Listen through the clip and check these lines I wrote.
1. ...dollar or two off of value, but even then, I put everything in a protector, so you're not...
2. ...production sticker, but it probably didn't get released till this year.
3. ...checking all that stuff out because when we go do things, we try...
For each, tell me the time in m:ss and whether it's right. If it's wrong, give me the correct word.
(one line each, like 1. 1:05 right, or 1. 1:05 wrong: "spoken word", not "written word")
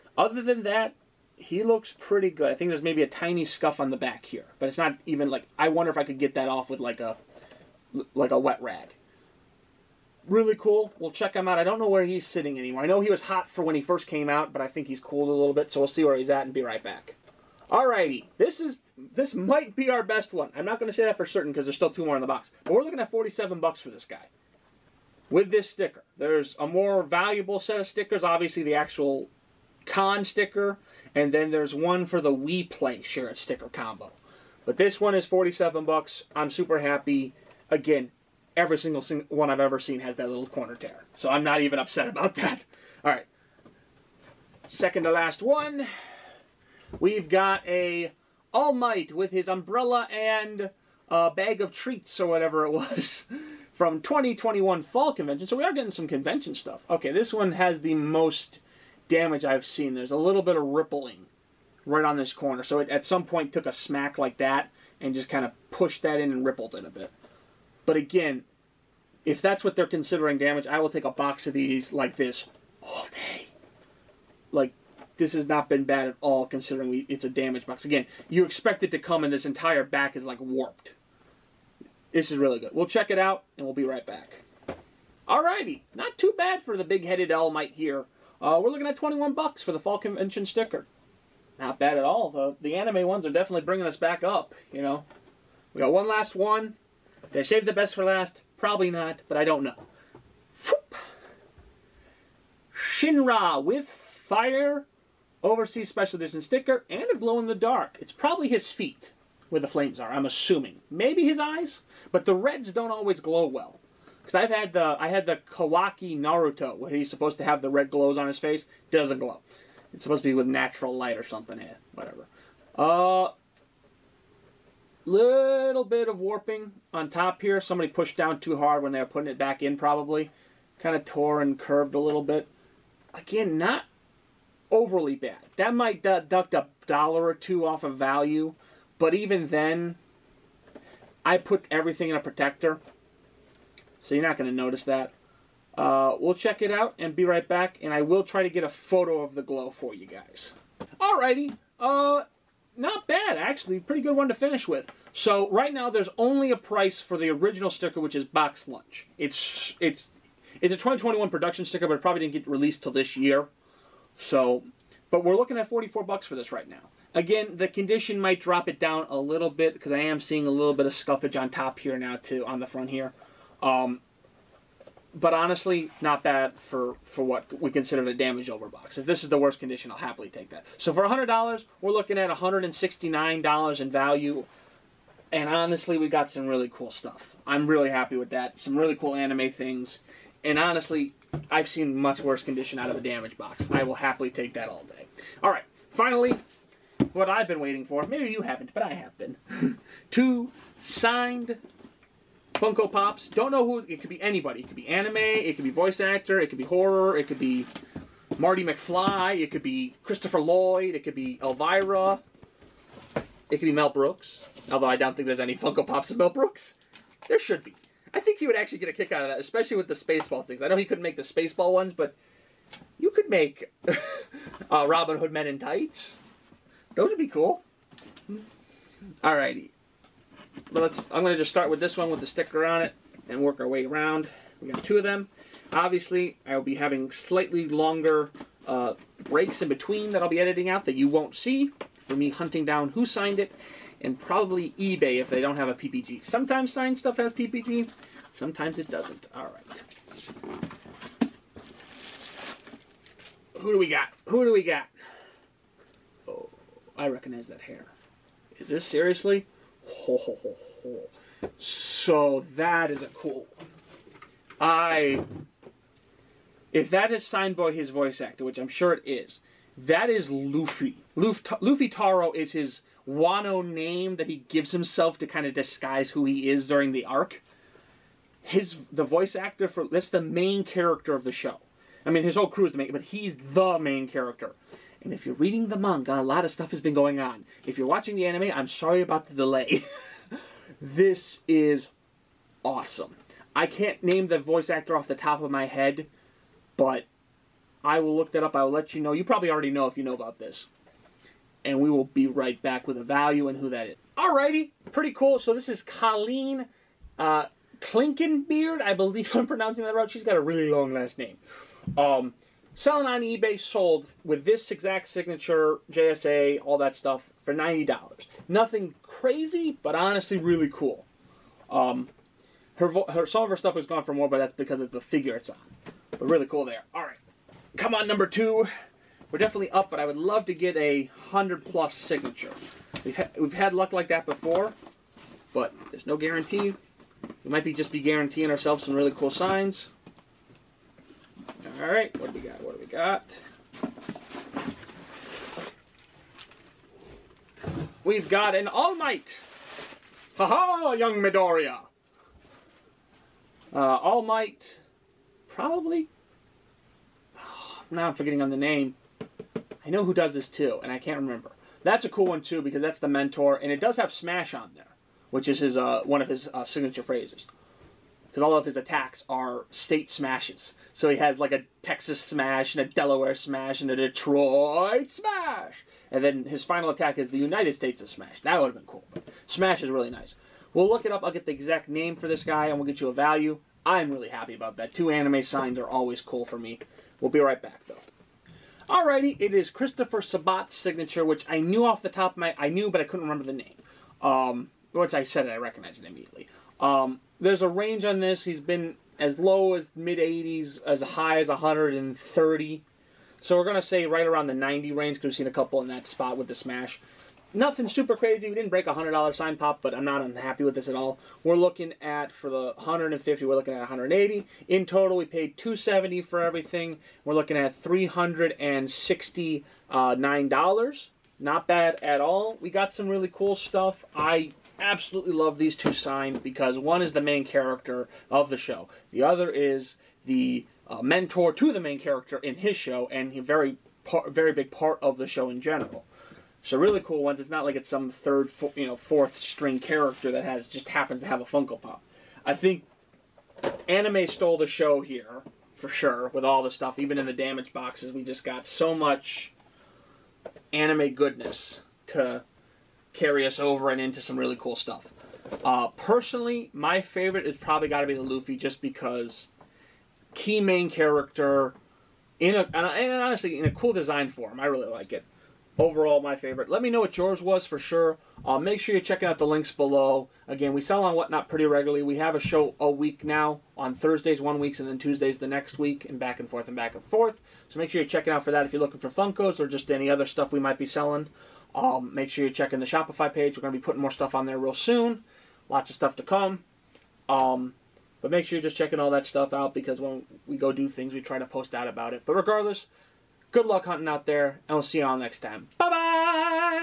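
1. 2:16 right
2. 2:41 right
3. 8:08 right.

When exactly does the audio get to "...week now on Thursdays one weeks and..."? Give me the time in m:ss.
7:52.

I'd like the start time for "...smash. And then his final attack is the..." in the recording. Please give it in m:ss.
6:15.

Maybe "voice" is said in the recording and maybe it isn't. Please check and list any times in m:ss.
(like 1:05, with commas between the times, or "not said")
3:25, 4:27, 4:39, 4:54.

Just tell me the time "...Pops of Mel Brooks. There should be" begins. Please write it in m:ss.
3:35.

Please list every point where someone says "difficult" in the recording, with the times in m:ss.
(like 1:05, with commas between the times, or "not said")
not said.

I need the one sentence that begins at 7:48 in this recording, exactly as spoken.
Uh, make sure you're checking out the links below.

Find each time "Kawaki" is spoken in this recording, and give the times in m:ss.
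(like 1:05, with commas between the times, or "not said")
1:55.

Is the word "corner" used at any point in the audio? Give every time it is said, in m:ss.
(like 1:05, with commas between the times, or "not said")
0:40, 1:02.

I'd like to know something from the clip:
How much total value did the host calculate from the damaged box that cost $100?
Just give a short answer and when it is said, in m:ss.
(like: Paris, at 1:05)
$169, at 3:02.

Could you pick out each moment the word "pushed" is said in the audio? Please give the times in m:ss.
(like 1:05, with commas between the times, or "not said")
1:05, 2:07.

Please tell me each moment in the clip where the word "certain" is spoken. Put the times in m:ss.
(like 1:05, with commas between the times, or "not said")
0:21.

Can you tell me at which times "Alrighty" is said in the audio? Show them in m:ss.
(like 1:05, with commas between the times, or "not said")
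0:17, 1:25, 2:31, 3:49, 5:04, 6:28.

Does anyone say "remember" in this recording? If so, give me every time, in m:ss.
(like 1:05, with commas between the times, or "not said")
6:01, 6:33.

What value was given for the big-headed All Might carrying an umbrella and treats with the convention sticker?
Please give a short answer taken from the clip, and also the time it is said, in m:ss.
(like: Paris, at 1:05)
$21, at 1:28.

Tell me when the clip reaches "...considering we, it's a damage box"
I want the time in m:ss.
1:16.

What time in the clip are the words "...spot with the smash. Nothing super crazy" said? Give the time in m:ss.
6:46.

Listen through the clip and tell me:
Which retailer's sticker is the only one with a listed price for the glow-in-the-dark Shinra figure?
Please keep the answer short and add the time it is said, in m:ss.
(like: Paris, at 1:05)
BoxLunch, at 2:38.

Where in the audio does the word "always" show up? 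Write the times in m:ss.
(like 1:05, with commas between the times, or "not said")
1:52, 6:25.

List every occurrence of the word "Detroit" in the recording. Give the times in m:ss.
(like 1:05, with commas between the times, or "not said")
6:13.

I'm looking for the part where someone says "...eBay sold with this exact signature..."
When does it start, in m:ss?
5:13.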